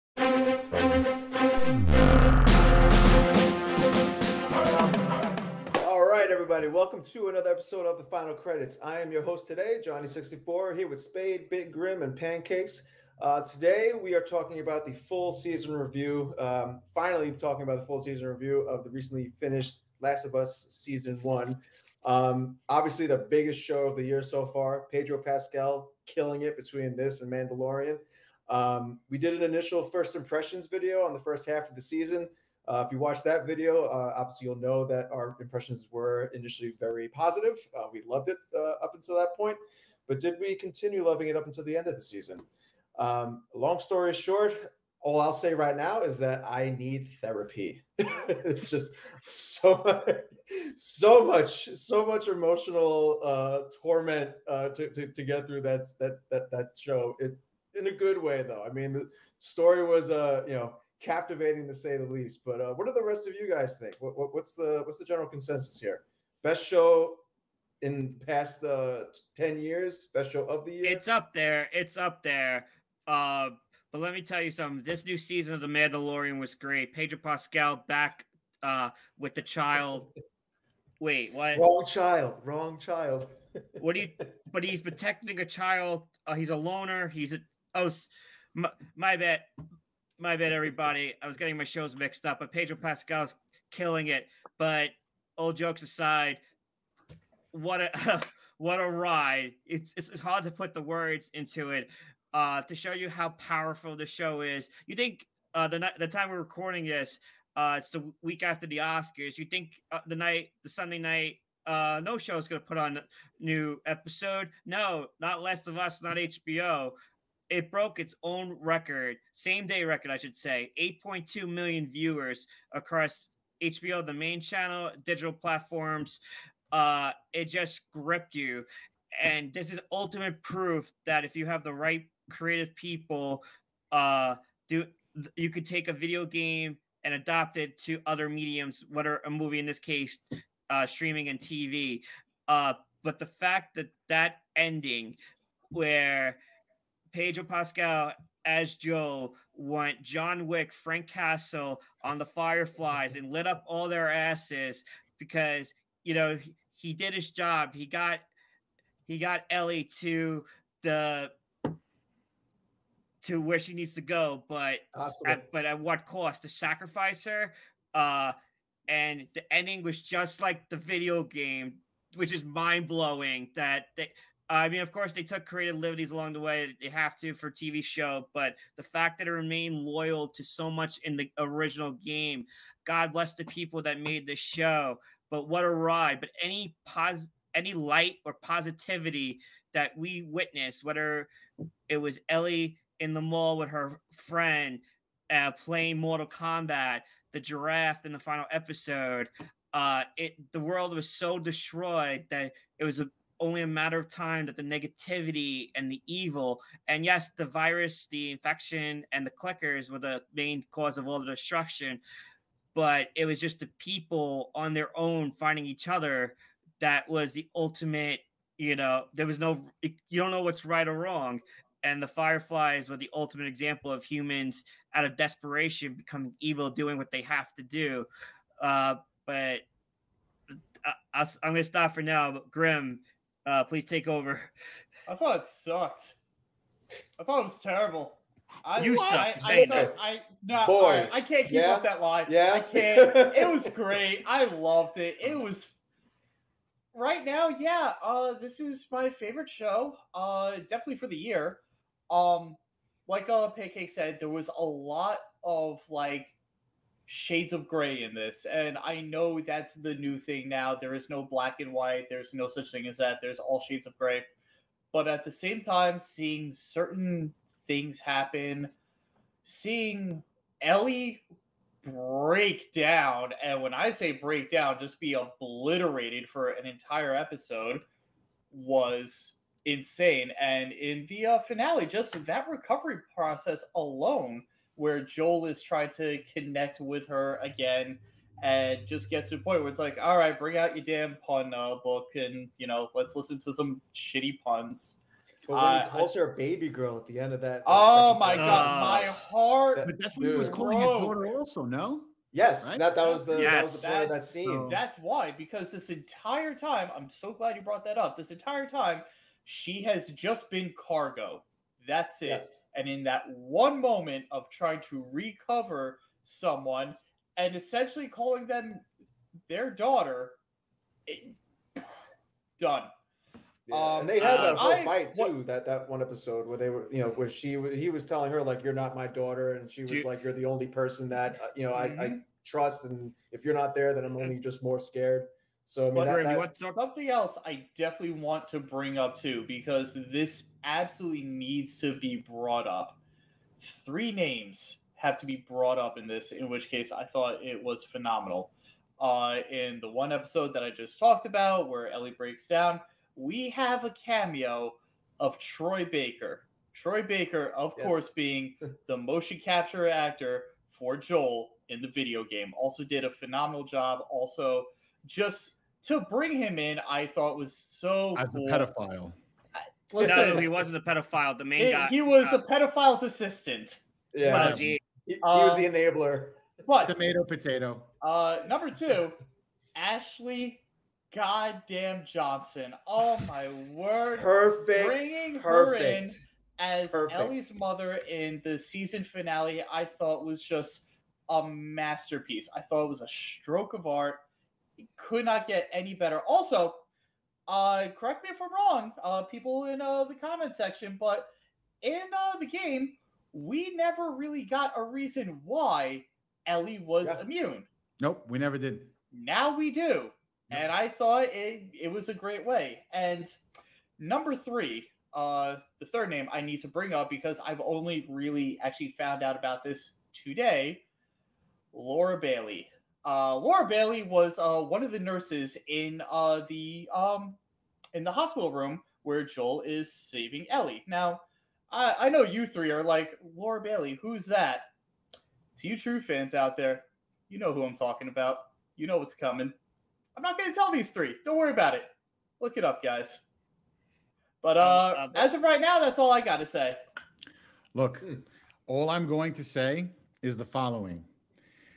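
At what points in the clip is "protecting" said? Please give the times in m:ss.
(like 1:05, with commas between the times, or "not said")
1:24.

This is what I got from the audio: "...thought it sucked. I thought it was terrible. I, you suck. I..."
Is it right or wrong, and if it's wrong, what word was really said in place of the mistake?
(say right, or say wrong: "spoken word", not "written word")
right.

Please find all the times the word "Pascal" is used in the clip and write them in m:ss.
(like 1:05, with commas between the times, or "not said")
0:25, 1:17, 1:32, 2:27.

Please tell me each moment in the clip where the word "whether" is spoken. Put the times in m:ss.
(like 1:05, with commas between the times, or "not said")
2:18, 3:10.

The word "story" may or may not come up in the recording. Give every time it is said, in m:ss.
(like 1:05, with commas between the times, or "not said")
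0:43, 0:59.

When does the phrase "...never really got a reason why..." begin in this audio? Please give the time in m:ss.
6:43.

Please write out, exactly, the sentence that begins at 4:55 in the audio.
But when he uh, calls her a baby girl at the end of that.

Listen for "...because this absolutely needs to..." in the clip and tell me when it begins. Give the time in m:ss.
5:39.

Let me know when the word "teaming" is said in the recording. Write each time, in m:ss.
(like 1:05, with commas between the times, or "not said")
not said.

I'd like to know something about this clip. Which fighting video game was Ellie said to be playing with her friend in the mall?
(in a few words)
Mortal Kombat.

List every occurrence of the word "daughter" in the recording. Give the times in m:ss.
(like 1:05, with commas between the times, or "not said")
5:00, 5:19, 5:29.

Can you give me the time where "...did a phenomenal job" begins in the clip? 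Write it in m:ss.
6:02.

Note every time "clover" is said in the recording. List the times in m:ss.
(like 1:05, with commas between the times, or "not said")
not said.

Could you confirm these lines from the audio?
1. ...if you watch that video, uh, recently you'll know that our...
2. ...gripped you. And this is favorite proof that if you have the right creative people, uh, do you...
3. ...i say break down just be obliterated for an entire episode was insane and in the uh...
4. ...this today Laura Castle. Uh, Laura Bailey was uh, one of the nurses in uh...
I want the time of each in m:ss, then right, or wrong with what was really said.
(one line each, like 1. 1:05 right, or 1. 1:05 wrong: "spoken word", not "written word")
1. 0:32 wrong: "obviously", not "recently"
2. 2:07 wrong: "ultimate", not "favorite"
3. 4:33 right
4. 6:59 wrong: "Bailey", not "Castle".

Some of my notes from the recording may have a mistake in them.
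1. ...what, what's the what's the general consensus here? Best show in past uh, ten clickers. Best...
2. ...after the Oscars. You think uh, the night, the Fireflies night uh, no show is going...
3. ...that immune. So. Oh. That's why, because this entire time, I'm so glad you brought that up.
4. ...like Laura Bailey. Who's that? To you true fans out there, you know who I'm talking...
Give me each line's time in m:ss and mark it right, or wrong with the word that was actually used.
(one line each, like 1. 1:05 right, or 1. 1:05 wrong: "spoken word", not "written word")
1. 1:04 wrong: "years", not "clickers"
2. 1:48 wrong: "Sunday", not "Fireflies"
3. 5:04 wrong: "scene", not "immune"
4. 7:12 right.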